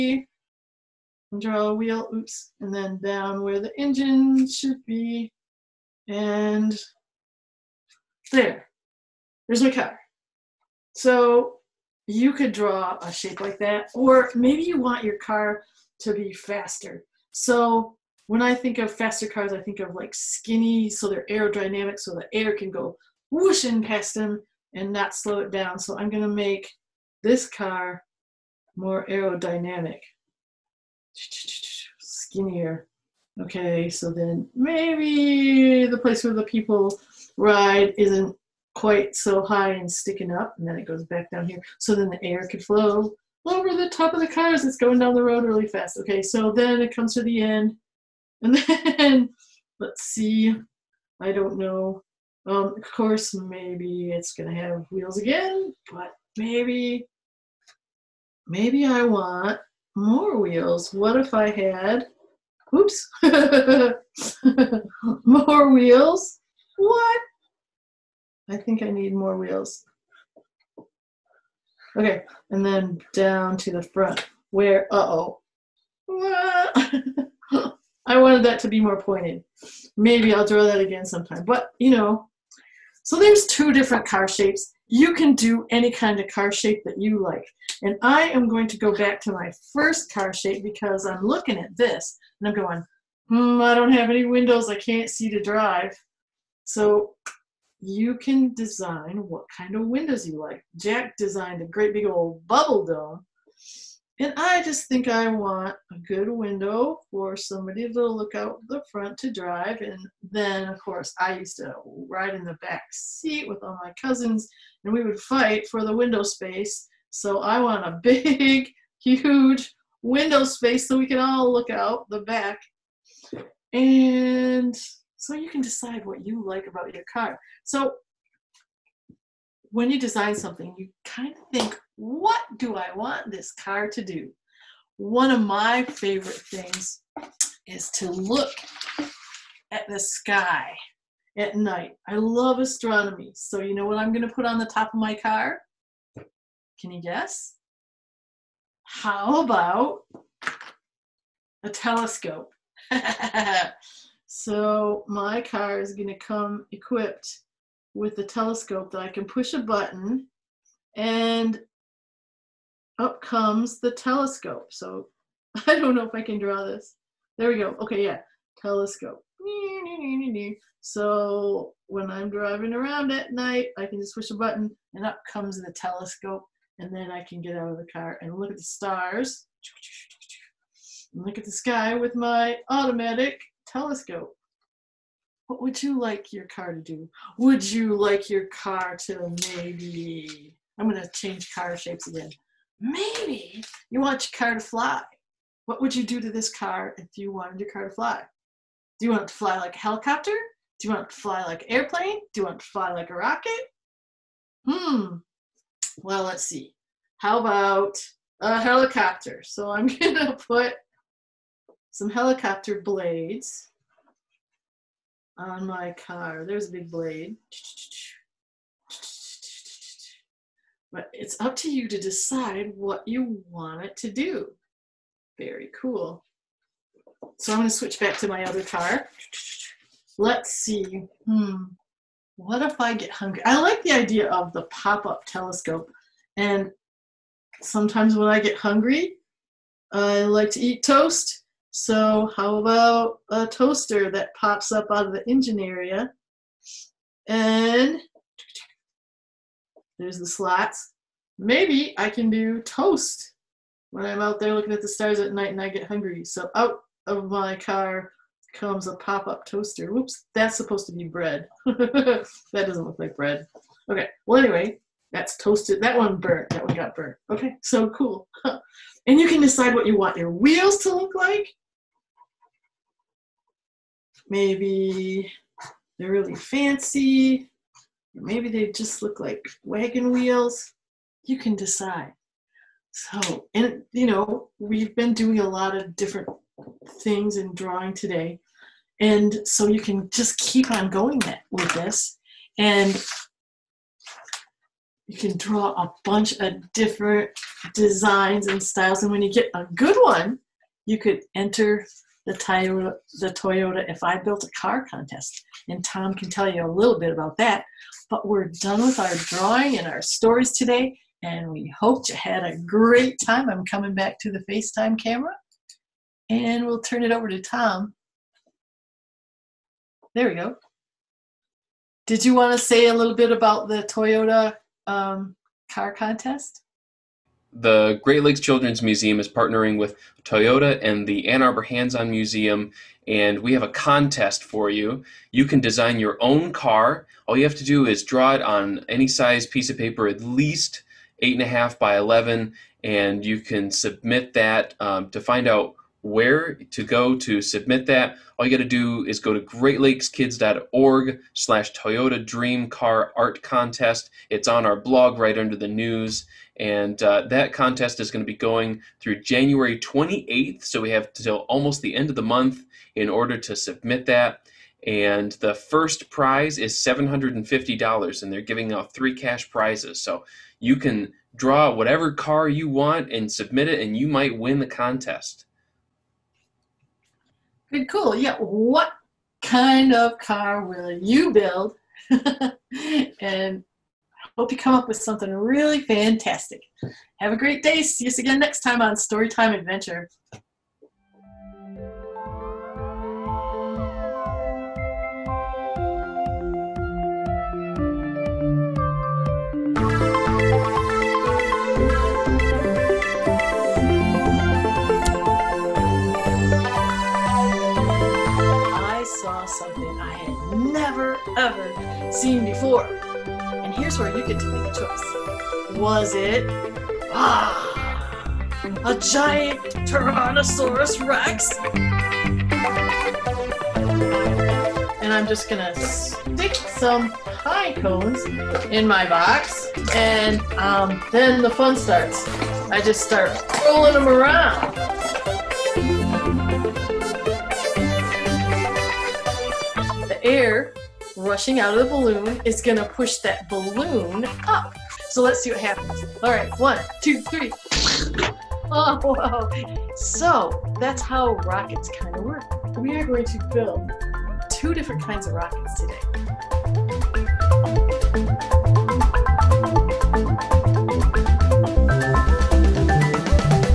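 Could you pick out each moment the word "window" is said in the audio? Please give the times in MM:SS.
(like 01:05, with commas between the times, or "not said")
01:34, 01:39, 01:46, 01:55, 02:00.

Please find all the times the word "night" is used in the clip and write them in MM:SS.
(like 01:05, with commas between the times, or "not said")
02:21, 02:53, 04:15.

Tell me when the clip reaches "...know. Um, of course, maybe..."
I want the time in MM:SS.
00:51.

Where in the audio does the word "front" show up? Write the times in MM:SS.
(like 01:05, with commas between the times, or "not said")
01:13, 01:48.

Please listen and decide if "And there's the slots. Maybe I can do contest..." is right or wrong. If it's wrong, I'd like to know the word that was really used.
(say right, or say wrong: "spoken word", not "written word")
wrong: "toast", not "contest".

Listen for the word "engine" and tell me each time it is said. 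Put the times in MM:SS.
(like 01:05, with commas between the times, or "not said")
00:03, 04:05.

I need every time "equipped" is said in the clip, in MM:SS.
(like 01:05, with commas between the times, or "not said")
02:36.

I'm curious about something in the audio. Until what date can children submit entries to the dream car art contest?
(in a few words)
January 28th.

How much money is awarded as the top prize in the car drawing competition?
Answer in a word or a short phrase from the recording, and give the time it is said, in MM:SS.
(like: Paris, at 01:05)
$750, at 06:06.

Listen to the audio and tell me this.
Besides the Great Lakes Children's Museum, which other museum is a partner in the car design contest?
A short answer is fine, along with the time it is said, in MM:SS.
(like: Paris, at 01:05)
Ann Arbor Hands On Museum, at 05:31.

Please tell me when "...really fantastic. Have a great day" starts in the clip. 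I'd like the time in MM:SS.
06:25.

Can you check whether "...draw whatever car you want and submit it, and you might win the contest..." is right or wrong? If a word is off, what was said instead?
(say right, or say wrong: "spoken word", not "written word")
right.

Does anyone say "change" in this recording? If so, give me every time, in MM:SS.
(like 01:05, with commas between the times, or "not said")
03:11.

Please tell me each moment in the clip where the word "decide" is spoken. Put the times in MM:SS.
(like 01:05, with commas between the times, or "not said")
02:05, 03:42, 04:29, 04:41.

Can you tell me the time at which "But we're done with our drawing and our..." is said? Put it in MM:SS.
05:08.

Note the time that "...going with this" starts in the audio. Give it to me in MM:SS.
04:50.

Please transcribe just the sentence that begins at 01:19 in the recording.
Maybe I'll draw that again sometime.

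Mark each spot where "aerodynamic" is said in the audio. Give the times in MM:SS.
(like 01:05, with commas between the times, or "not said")
00:21, 00:29.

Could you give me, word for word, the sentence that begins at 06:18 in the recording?
Yeah, what kind of car will you build?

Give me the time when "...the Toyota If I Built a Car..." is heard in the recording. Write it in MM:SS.
05:03.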